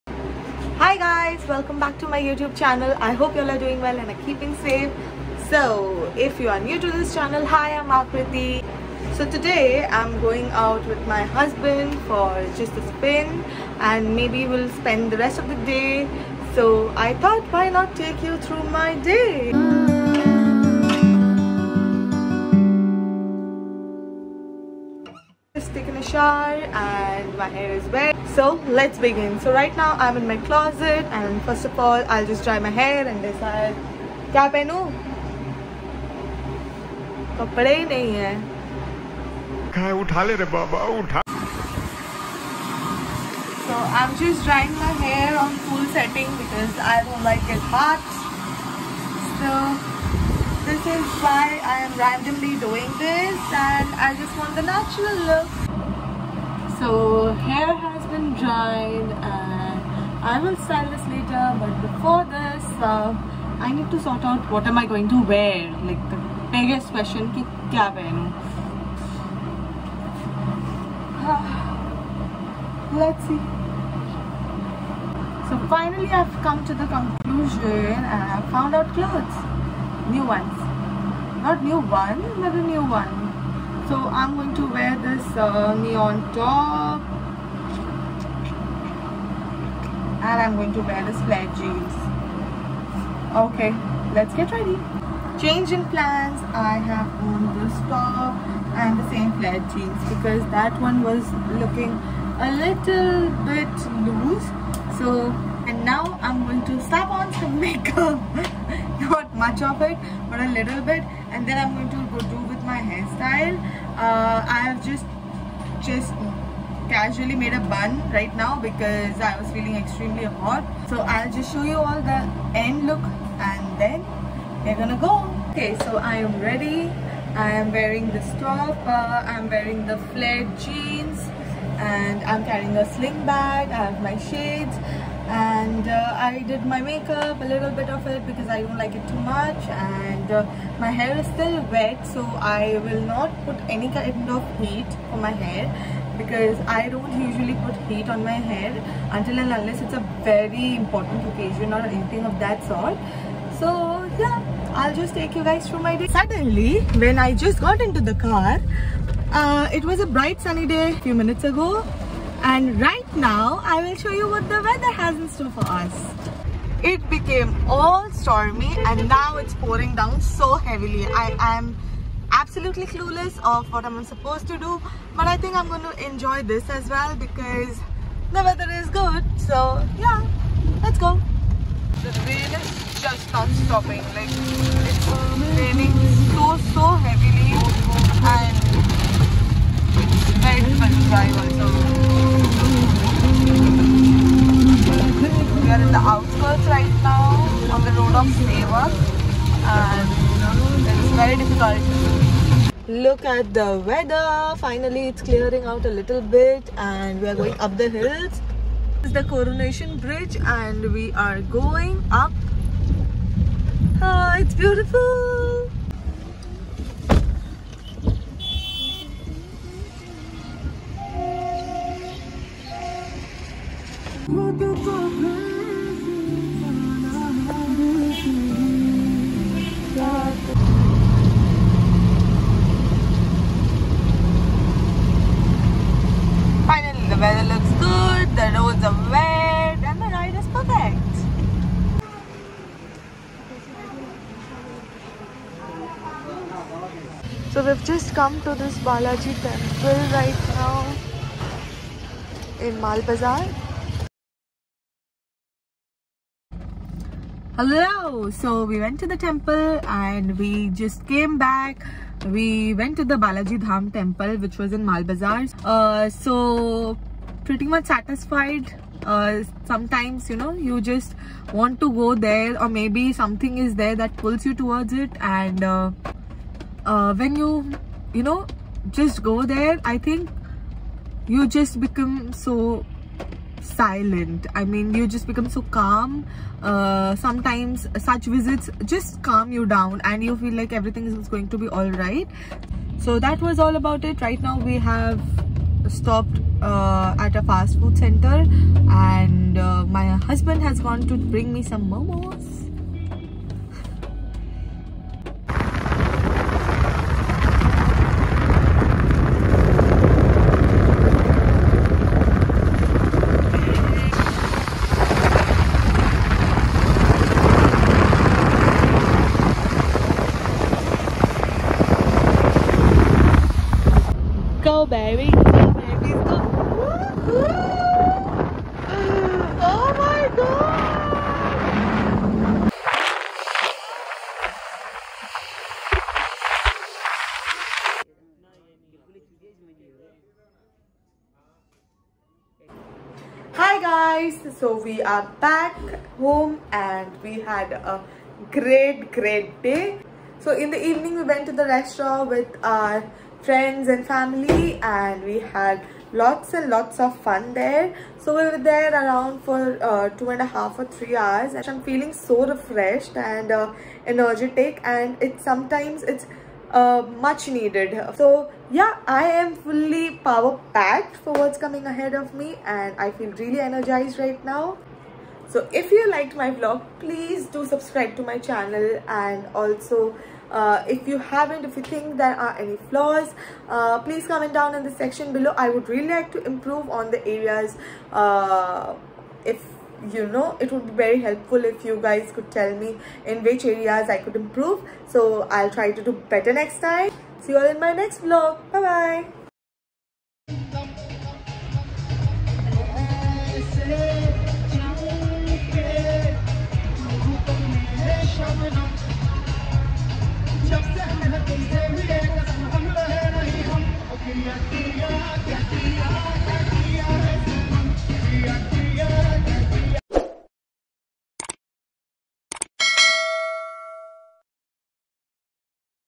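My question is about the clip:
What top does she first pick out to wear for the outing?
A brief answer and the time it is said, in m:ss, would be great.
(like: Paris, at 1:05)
neon, at 1:25.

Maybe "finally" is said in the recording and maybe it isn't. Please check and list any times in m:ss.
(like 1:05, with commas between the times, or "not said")
1:15, 3:24.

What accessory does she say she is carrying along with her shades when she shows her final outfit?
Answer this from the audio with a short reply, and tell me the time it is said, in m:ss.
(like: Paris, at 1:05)
sling bag, at 2:12.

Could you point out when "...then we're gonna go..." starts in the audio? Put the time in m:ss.
2:03.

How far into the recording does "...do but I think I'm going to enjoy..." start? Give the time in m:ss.
2:54.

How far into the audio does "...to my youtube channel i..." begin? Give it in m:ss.
0:01.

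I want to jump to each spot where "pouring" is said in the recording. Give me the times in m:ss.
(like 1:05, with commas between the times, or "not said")
2:49.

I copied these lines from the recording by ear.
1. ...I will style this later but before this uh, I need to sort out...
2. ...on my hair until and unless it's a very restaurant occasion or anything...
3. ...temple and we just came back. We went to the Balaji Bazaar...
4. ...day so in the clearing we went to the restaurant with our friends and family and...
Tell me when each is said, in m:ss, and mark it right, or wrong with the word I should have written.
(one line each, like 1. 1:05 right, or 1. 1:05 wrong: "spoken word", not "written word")
1. 1:00 right
2. 2:28 wrong: "important", not "restaurant"
3. 4:19 wrong: "Dham", not "Bazaar"
4. 5:49 wrong: "evening", not "clearing".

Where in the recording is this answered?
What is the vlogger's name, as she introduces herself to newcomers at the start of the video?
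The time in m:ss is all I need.
0:07.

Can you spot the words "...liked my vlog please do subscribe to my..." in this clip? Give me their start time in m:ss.
6:16.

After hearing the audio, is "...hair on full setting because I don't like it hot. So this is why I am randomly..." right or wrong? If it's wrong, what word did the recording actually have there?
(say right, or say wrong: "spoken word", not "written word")
right.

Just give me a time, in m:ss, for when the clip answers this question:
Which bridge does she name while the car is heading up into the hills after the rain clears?
3:29.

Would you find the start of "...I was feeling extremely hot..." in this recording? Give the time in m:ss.
1:59.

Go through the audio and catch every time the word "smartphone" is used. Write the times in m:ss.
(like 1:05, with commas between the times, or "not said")
not said.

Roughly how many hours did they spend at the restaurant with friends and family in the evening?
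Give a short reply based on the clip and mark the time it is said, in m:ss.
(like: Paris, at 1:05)
2.5 or 3 hours, at 6:00.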